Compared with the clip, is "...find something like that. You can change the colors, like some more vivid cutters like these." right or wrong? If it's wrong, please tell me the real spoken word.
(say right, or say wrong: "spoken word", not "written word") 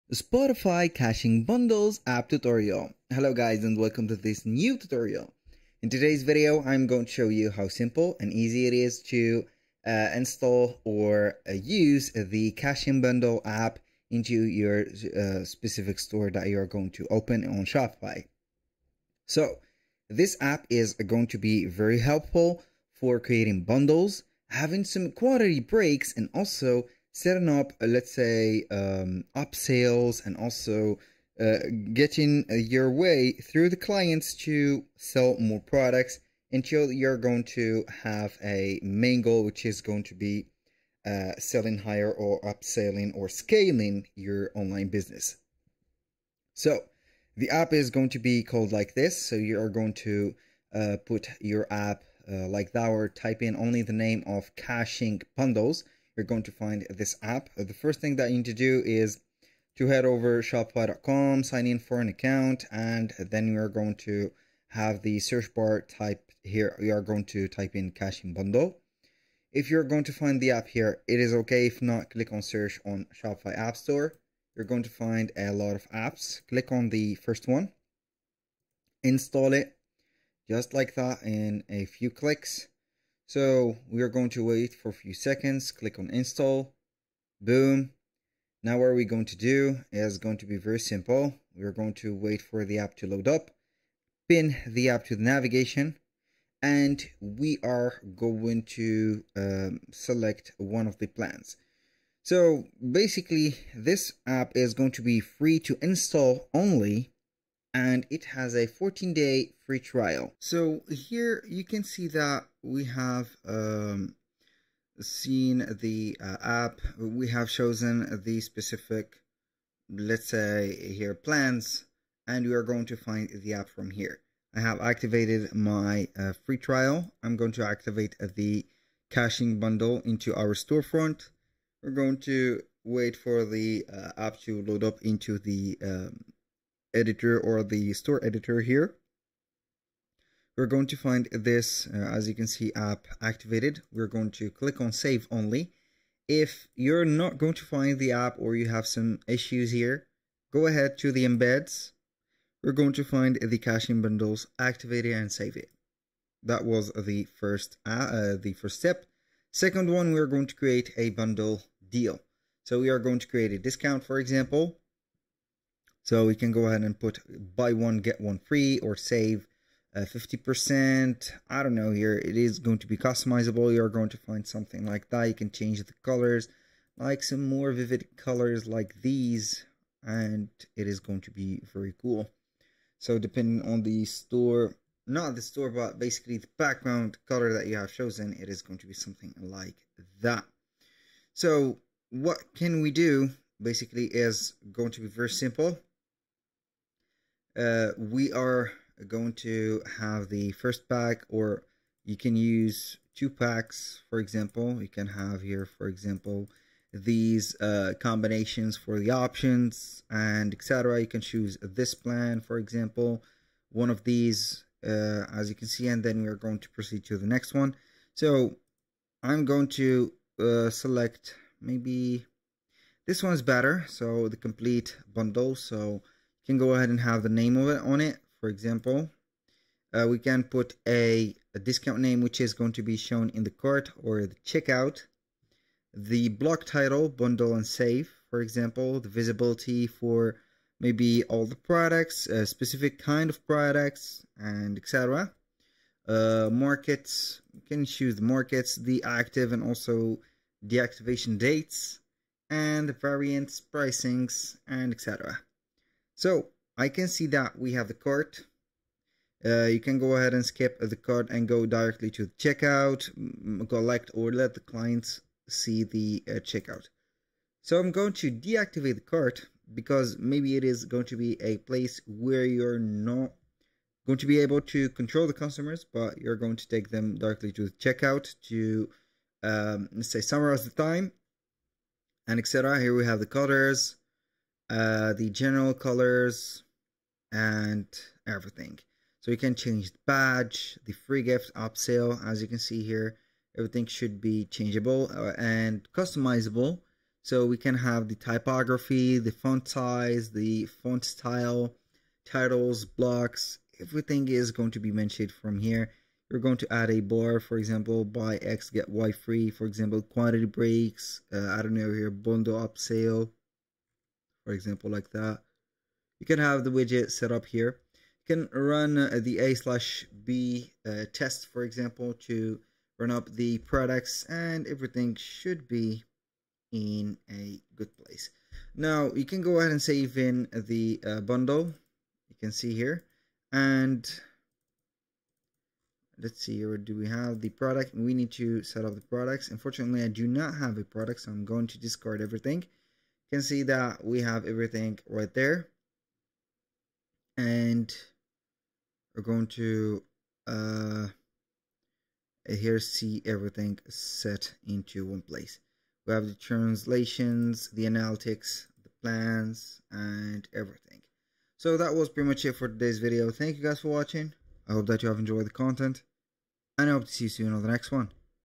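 wrong: "colors", not "cutters".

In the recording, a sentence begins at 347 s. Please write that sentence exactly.
And we're going to uh, here see everything set into one place.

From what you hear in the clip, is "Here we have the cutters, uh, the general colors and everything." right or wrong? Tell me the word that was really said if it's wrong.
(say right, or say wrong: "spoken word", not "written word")
right.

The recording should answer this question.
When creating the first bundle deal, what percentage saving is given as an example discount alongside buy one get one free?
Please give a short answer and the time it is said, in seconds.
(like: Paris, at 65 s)
50%, at 169 s.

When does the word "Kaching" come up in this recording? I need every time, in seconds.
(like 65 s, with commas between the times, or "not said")
0 s, 12 s, 54 s, 67 s, 129 s, 153 s.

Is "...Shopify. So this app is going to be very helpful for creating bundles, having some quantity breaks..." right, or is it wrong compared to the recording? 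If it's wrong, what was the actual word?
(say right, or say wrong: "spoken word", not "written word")
right.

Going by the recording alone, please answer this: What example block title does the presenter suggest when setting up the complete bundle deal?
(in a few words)
Bundle and save.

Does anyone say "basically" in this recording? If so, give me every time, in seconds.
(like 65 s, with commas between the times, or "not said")
102 s, 185 s, 193 s.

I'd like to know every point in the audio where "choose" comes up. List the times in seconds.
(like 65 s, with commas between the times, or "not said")
211 s, 247 s.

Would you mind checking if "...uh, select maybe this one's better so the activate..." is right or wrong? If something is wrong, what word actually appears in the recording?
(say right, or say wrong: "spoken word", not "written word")
wrong: "complete", not "activate".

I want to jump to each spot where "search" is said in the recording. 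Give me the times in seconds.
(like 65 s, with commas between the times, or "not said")
65 s, 72 s.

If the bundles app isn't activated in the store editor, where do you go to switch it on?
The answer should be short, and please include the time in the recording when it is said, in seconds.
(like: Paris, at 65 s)
the embeds, at 151 s.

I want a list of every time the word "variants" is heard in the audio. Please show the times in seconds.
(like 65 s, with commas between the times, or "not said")
252 s.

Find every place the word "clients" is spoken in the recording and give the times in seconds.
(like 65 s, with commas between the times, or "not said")
33 s, 264 s.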